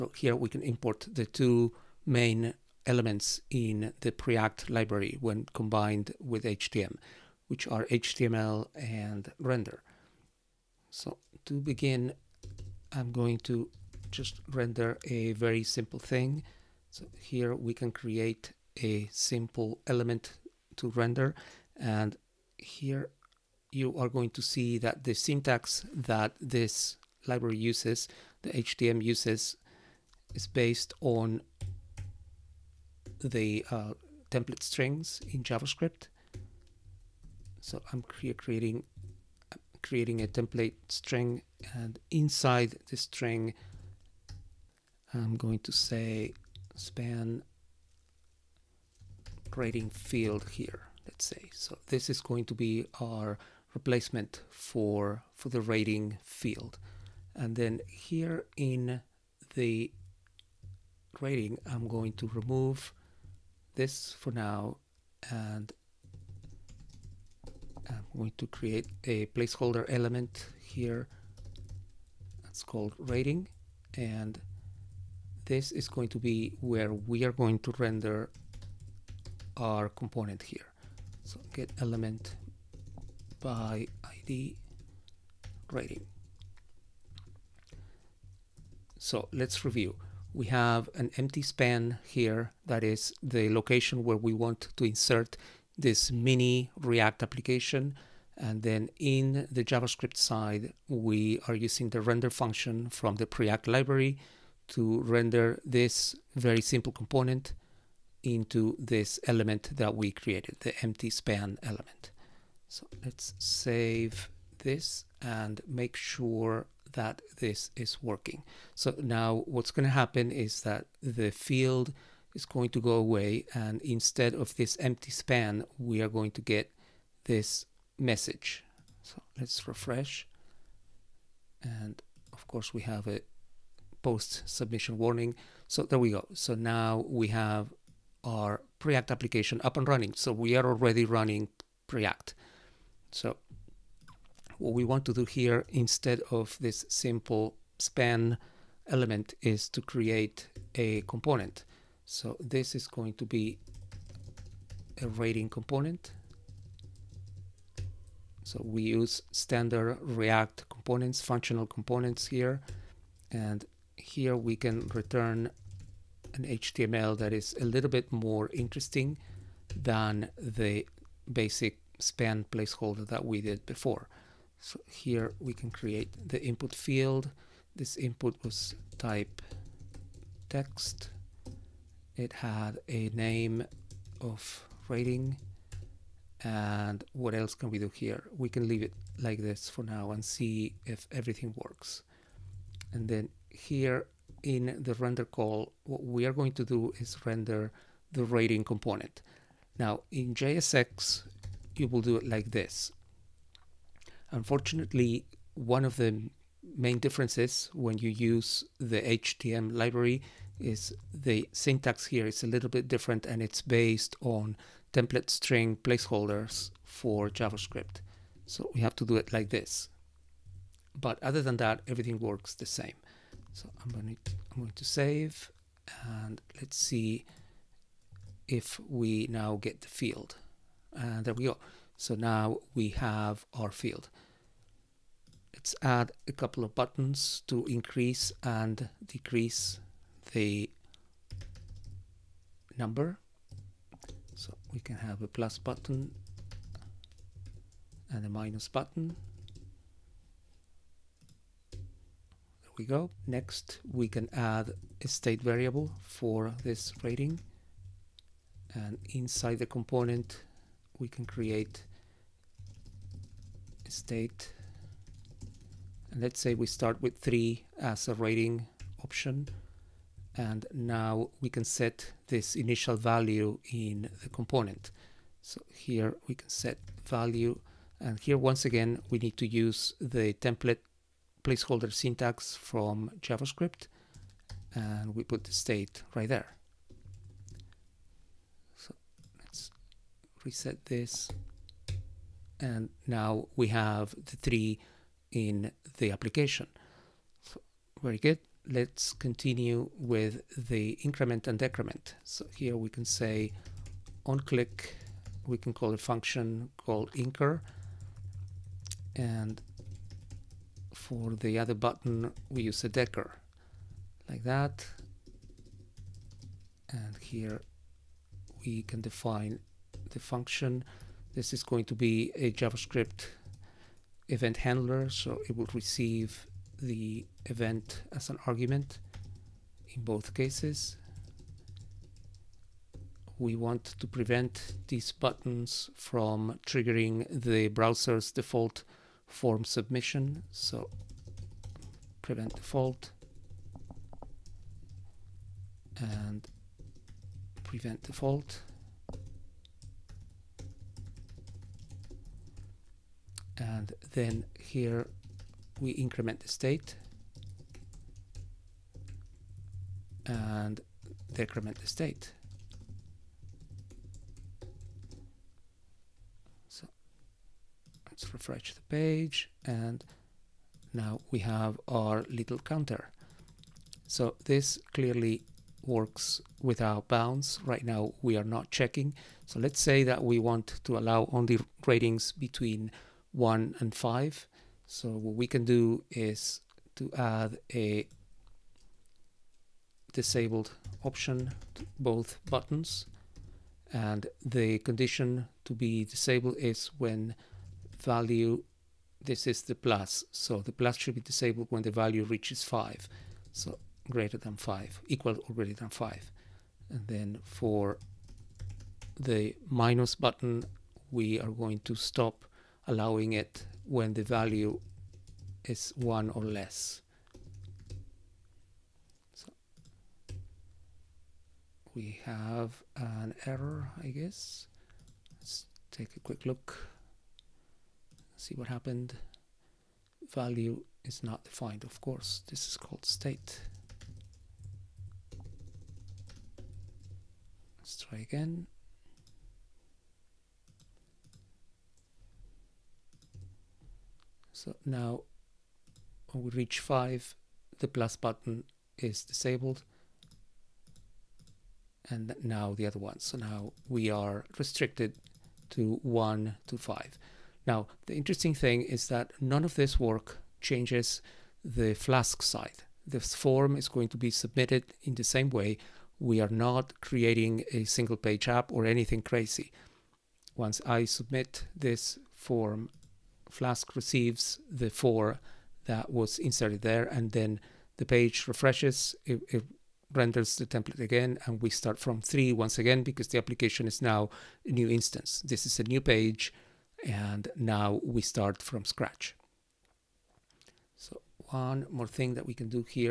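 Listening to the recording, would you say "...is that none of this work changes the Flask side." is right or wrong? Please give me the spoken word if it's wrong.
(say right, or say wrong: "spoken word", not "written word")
right.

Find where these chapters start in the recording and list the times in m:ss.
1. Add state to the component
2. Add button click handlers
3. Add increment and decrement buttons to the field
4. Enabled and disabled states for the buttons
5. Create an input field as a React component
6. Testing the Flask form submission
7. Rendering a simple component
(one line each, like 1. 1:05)
1. 4:11
2. 4:56
3. 3:53
4. 6:13
5. 2:22
6. 7:36
7. 0:09.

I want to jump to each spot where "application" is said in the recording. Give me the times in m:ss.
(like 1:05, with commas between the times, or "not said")
1:37, 2:19, 4:56, 8:03.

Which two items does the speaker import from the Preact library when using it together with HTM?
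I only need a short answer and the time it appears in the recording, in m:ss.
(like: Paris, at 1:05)
HTML and render, at 0:07.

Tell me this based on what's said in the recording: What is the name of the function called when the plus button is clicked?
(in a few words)
incur.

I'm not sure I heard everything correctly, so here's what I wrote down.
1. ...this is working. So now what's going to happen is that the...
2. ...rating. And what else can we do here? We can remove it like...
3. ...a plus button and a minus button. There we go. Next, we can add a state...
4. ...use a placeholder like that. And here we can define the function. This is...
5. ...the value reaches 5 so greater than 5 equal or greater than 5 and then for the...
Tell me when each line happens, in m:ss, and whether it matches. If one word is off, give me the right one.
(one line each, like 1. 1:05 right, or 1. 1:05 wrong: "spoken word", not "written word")
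1. 1:57 right
2. 3:04 wrong: "leave", not "remove"
3. 4:05 right
4. 5:12 wrong: "decker", not "placeholder"
5. 6:41 right.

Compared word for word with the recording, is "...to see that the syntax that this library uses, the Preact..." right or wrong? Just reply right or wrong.
wrong.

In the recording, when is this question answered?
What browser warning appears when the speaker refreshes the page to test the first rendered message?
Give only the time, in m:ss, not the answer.
2:14.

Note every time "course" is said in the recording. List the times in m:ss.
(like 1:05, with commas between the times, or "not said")
2:12, 7:12.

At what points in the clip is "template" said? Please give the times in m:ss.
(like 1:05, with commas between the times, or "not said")
0:34, 0:40, 3:34, 4:40, 8:00.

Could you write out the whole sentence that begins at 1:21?
So get element by ID rating.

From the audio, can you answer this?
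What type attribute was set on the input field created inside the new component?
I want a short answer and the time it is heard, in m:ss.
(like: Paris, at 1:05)
text, at 2:58.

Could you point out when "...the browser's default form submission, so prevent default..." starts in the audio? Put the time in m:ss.
5:37.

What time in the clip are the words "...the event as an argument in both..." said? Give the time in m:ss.
5:26.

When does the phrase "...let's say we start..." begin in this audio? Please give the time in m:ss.
4:26.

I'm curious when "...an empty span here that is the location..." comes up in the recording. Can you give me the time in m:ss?
1:30.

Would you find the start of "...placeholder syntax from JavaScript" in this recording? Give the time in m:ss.
4:41.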